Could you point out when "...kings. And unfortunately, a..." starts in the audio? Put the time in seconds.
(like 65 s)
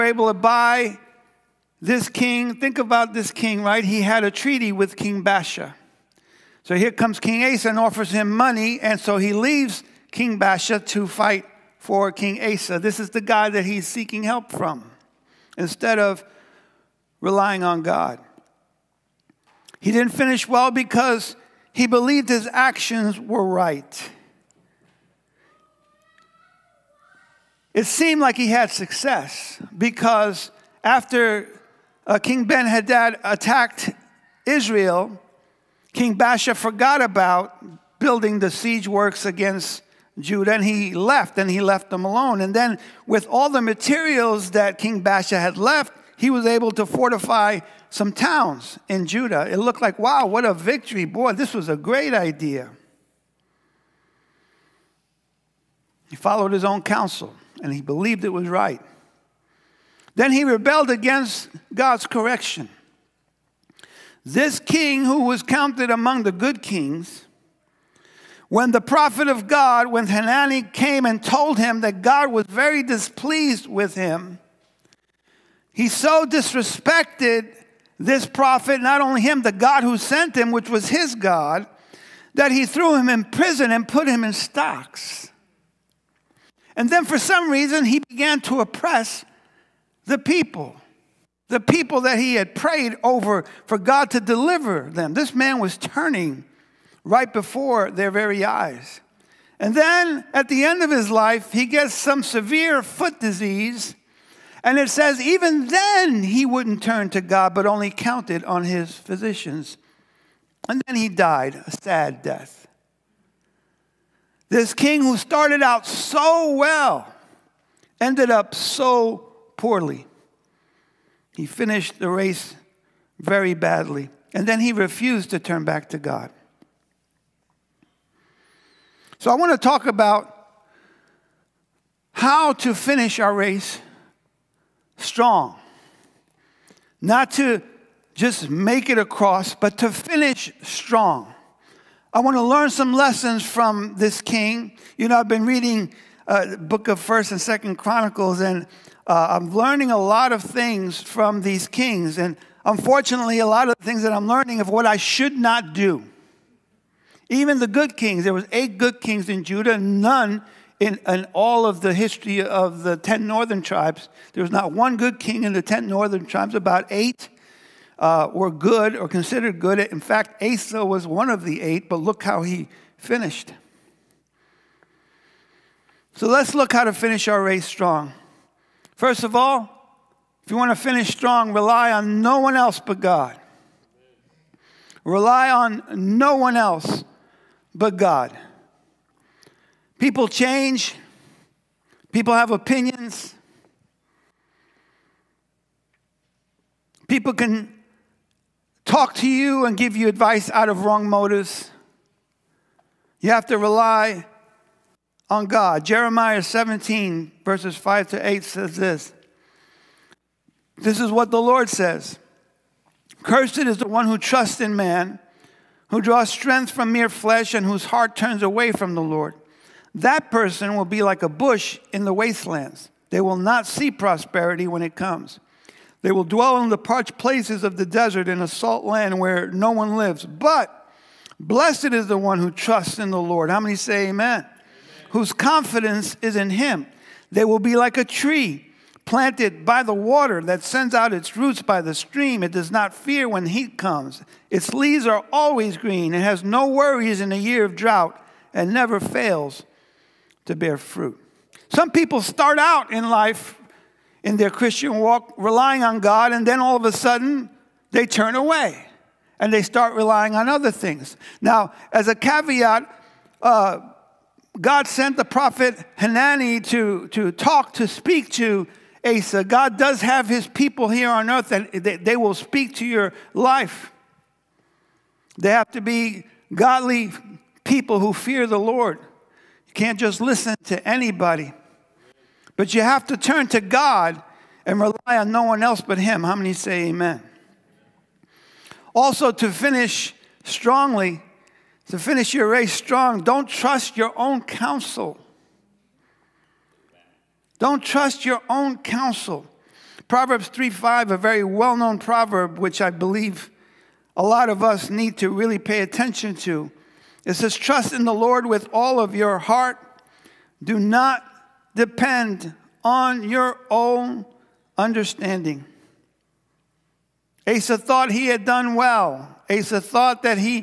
151 s.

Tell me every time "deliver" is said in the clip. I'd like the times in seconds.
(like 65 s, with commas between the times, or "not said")
94 s.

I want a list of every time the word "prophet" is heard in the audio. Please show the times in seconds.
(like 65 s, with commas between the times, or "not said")
68 s, 78 s, 265 s.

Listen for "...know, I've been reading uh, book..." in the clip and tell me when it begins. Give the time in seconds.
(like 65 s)
145 s.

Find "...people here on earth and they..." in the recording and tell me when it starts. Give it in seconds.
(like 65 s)
270 s.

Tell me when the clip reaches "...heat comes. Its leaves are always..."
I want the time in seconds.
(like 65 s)
243 s.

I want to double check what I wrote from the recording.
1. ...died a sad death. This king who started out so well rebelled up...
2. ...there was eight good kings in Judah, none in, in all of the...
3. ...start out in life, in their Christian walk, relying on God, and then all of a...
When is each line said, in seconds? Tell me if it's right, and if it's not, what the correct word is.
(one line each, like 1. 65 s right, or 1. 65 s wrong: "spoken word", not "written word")
1. 111 s wrong: "ended", not "rebelled"
2. 158 s right
3. 252 s right.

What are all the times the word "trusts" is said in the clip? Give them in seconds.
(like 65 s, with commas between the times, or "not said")
214 s, 232 s, 293 s, 297 s, 307 s.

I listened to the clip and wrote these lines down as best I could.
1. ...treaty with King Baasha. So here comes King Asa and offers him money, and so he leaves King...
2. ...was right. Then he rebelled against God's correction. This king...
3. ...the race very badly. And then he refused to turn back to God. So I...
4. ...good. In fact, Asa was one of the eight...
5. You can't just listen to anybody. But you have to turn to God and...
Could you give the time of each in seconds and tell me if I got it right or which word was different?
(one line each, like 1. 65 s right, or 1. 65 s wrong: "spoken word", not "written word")
1. 4 s right
2. 58 s right
3. 121 s right
4. 169 s right
5. 279 s right.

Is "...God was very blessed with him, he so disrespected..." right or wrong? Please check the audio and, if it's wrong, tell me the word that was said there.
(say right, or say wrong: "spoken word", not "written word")
wrong: "displeased", not "blessed".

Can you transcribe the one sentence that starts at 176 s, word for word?
So let's look how to finish our race strong.